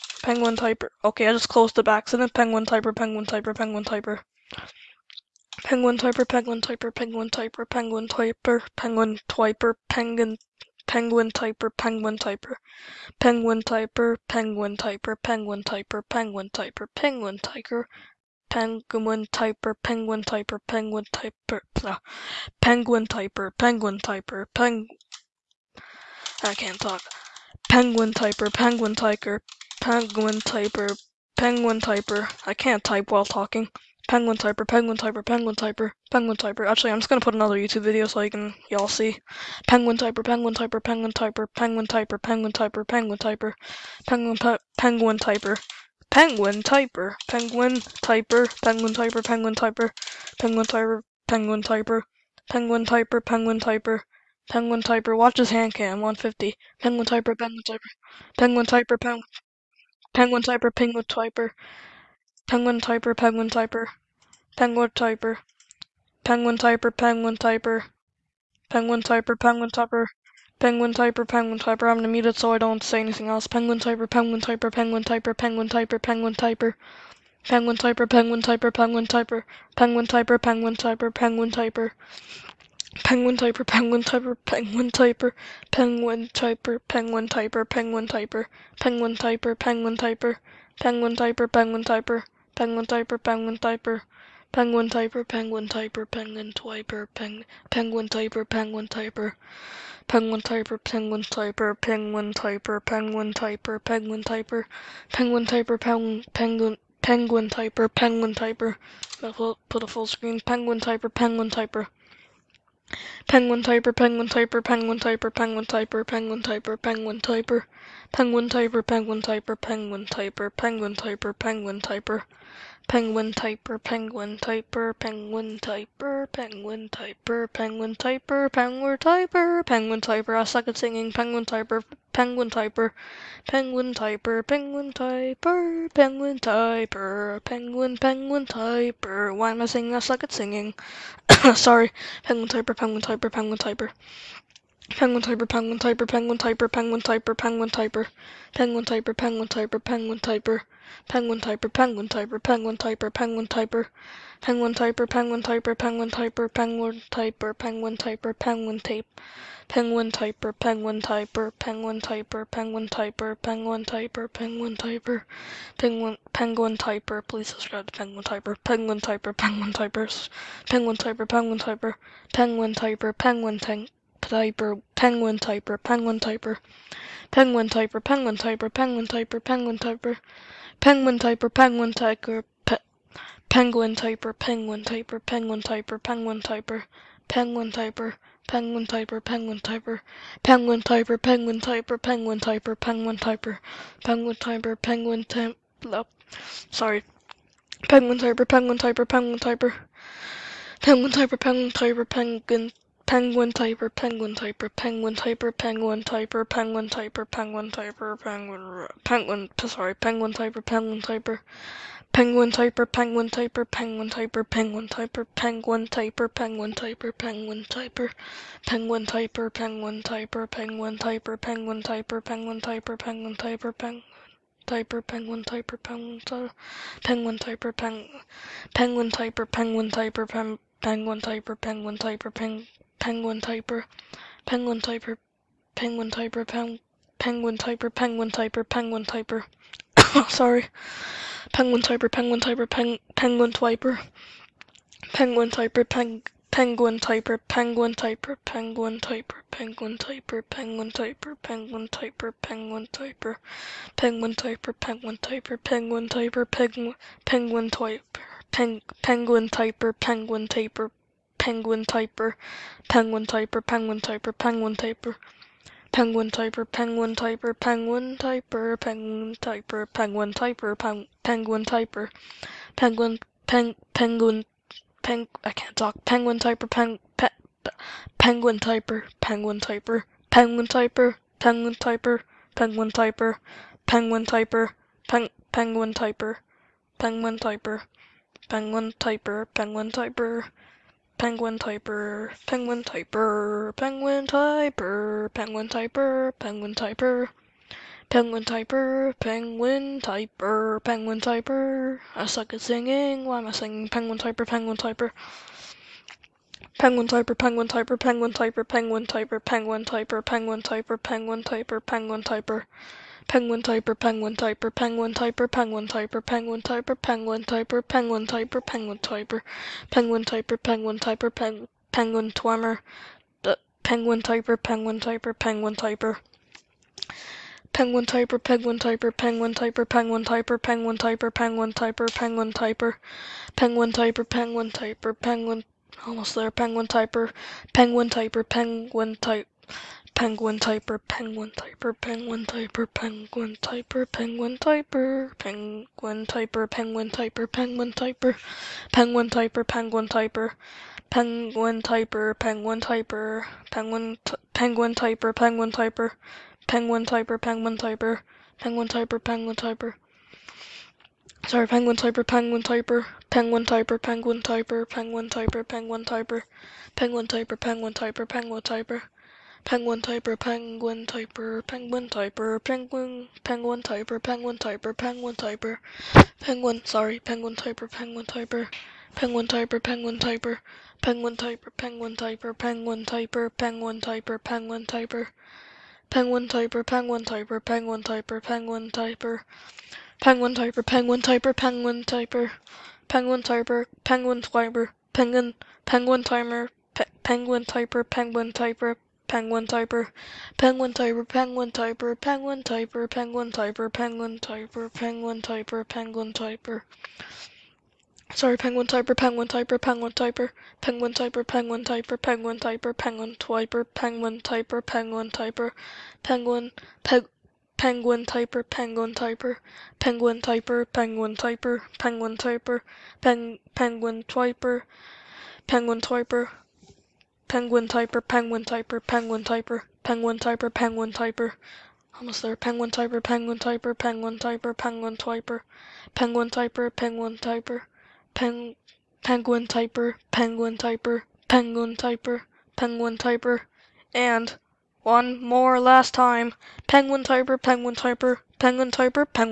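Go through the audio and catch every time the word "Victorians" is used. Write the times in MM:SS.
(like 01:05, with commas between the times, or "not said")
not said.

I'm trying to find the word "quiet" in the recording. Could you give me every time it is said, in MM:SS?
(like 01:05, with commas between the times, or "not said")
not said.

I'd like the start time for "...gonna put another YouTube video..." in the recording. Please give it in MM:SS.
00:37.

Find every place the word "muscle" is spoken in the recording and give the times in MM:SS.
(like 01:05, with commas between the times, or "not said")
not said.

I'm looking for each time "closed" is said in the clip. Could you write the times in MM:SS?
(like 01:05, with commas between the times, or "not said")
00:01.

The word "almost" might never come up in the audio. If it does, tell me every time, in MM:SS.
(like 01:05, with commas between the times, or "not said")
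05:36, 07:12.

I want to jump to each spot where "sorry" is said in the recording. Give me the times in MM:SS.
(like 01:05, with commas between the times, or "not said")
02:21, 03:29, 04:00, 06:01, 06:16, 06:48.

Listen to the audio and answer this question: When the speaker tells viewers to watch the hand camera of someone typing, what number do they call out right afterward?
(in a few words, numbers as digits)
150.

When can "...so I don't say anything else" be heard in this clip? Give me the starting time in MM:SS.
01:12.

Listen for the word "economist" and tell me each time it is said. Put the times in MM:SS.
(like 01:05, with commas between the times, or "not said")
not said.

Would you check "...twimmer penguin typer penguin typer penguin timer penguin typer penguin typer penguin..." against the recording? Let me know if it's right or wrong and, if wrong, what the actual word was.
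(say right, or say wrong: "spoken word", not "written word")
wrong: "typer", not "timer".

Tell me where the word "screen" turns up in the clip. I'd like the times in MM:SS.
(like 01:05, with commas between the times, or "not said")
01:50.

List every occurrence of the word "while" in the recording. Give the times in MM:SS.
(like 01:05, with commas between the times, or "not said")
00:33.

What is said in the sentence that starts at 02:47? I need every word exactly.
Please subscribe to penguin typer, penguin typer, penguin typers, penguin typer, penguin typer, penguin typer, penguin tank.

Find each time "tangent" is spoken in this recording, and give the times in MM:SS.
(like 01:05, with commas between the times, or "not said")
not said.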